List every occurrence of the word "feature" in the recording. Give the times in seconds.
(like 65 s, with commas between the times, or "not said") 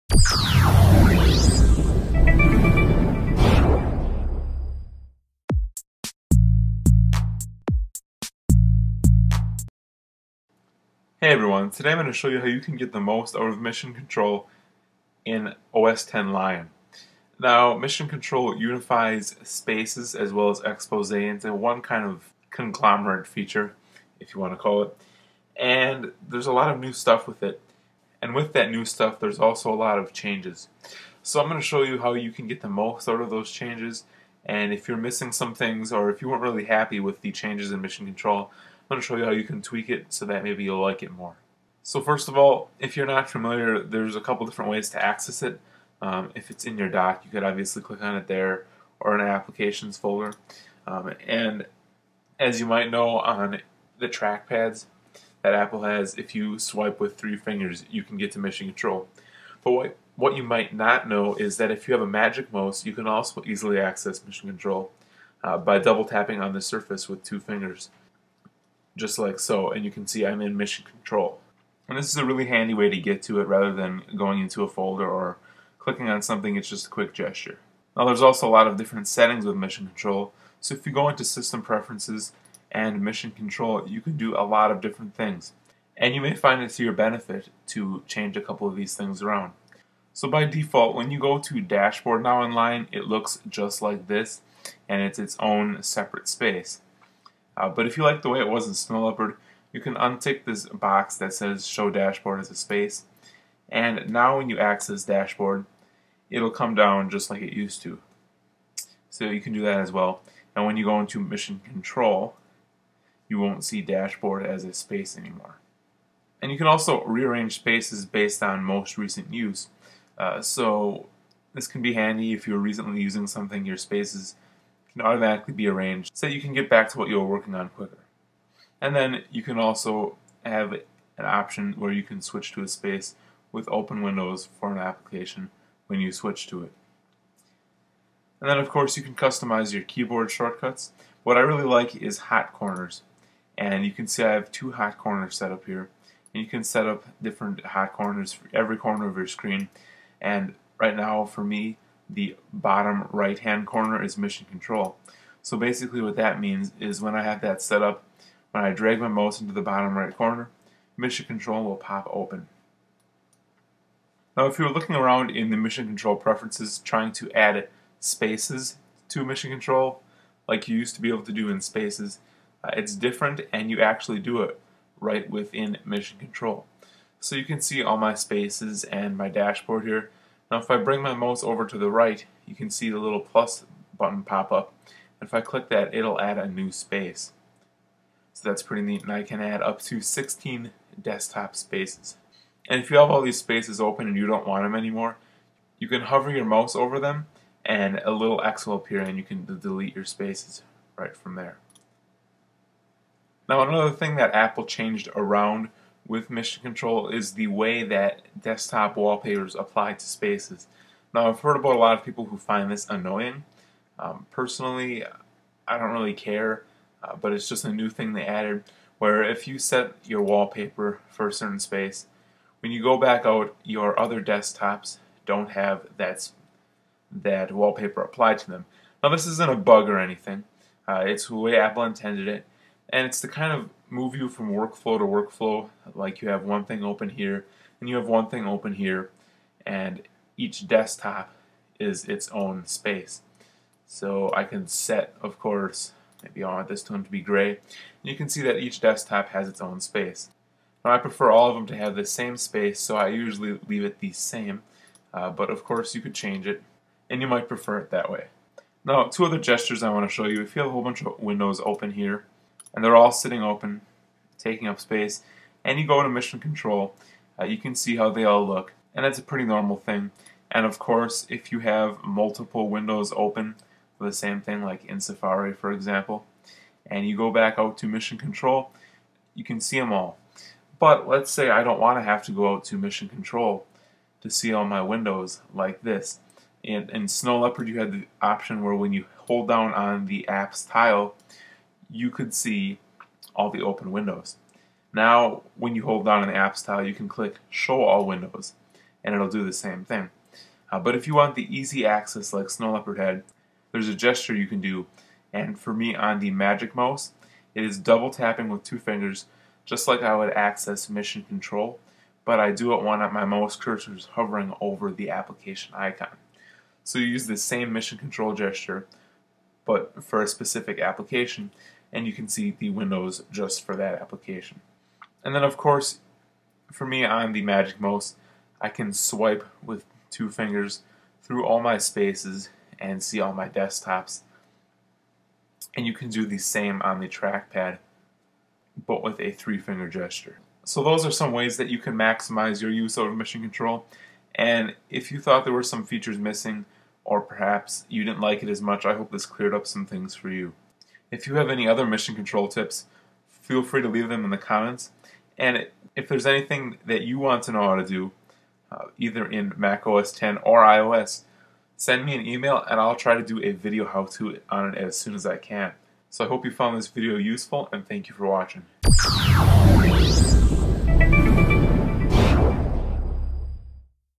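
23 s, 345 s.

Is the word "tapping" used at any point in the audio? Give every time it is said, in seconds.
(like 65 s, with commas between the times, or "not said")
66 s, 308 s.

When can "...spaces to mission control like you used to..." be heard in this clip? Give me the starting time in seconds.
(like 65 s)
167 s.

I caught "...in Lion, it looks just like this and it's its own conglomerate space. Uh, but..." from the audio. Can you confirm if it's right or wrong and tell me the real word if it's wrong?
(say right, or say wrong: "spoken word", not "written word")
wrong: "separate", not "conglomerate".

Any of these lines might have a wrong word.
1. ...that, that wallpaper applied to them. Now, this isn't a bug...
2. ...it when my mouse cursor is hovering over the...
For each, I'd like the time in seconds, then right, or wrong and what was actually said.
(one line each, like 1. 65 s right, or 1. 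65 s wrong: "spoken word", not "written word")
1. 225 s right
2. 312 s right.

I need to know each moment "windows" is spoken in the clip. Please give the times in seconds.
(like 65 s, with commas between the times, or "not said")
134 s, 261 s, 272 s, 284 s, 293 s, 298 s, 322 s.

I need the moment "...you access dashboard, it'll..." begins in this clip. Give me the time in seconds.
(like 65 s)
104 s.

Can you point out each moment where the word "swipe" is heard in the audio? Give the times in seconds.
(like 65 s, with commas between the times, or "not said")
56 s, 328 s.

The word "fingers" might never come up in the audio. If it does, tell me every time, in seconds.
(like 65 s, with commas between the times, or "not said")
57 s, 67 s, 308 s, 330 s, 339 s.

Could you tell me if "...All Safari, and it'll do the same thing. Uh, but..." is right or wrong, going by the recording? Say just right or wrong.
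wrong.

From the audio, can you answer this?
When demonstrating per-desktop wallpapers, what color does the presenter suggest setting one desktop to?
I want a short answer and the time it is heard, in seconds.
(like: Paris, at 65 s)
Gray, at 247 s.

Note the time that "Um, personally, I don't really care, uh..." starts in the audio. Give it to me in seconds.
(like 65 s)
213 s.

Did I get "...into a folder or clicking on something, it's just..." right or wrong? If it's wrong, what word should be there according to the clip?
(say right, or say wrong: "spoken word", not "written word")
right.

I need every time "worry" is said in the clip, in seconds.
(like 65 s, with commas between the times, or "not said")
not said.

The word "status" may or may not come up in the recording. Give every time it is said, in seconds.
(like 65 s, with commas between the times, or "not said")
not said.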